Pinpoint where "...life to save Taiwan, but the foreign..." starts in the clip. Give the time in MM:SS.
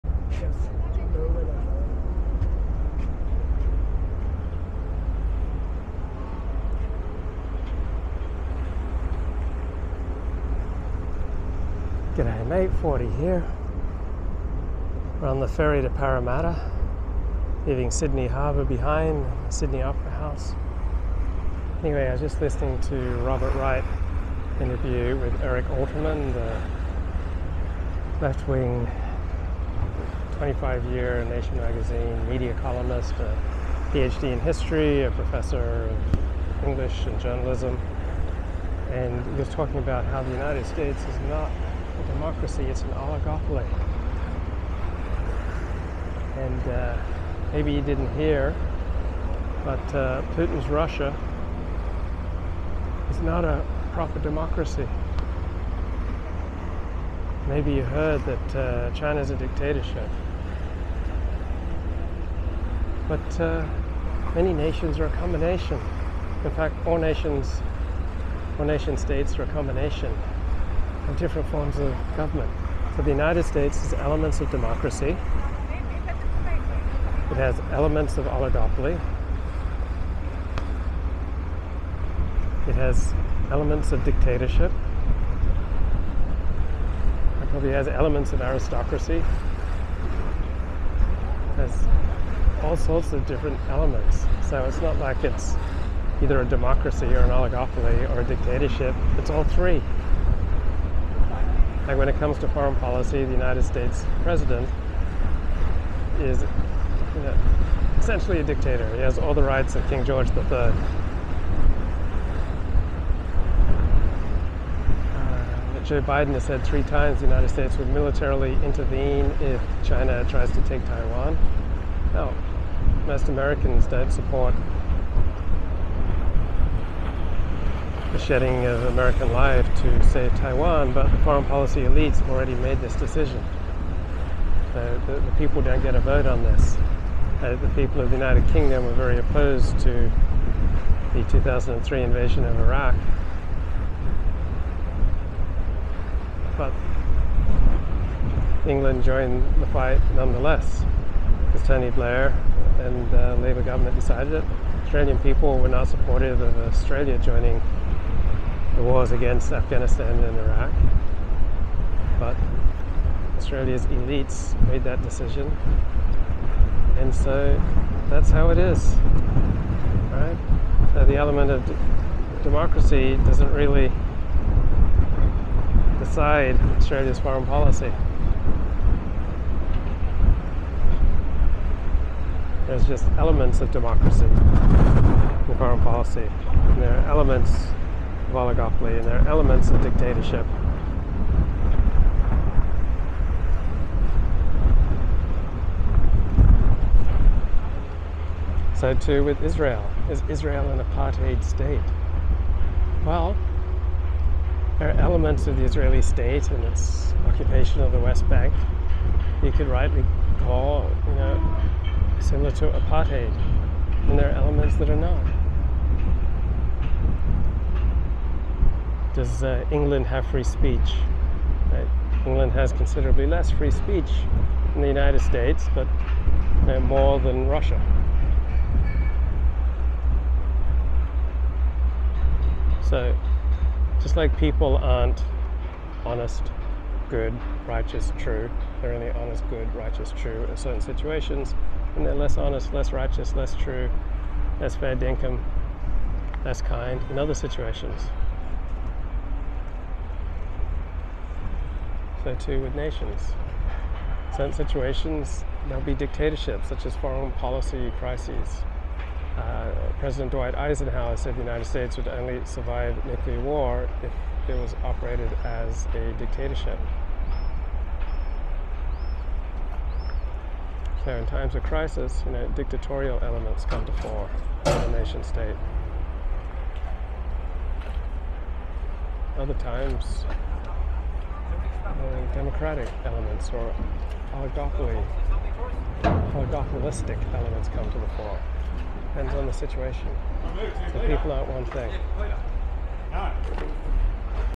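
02:09.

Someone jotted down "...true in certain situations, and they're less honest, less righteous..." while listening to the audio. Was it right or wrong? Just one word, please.
right.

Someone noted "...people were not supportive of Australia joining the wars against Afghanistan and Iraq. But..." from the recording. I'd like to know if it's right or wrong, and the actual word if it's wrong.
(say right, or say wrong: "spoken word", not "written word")
right.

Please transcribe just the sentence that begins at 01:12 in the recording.
So the United States has elements of democracy.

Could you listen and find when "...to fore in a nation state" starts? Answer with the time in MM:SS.
04:33.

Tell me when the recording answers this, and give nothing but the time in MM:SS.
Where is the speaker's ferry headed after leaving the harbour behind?
00:15.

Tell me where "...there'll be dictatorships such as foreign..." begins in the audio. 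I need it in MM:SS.
04:15.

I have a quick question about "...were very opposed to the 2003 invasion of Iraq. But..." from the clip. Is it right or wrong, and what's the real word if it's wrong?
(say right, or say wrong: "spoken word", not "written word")
right.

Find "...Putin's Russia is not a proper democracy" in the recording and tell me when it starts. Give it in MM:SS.
00:50.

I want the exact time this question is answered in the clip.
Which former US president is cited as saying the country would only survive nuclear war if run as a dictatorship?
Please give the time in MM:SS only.
04:20.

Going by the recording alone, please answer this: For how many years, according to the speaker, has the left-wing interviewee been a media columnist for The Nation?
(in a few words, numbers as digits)
25.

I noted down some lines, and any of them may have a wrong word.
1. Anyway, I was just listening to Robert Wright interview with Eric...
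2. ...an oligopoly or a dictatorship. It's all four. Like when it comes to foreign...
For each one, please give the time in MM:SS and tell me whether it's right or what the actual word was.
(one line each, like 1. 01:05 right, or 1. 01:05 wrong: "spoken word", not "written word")
1. 00:21 right
2. 01:37 wrong: "three", not "four".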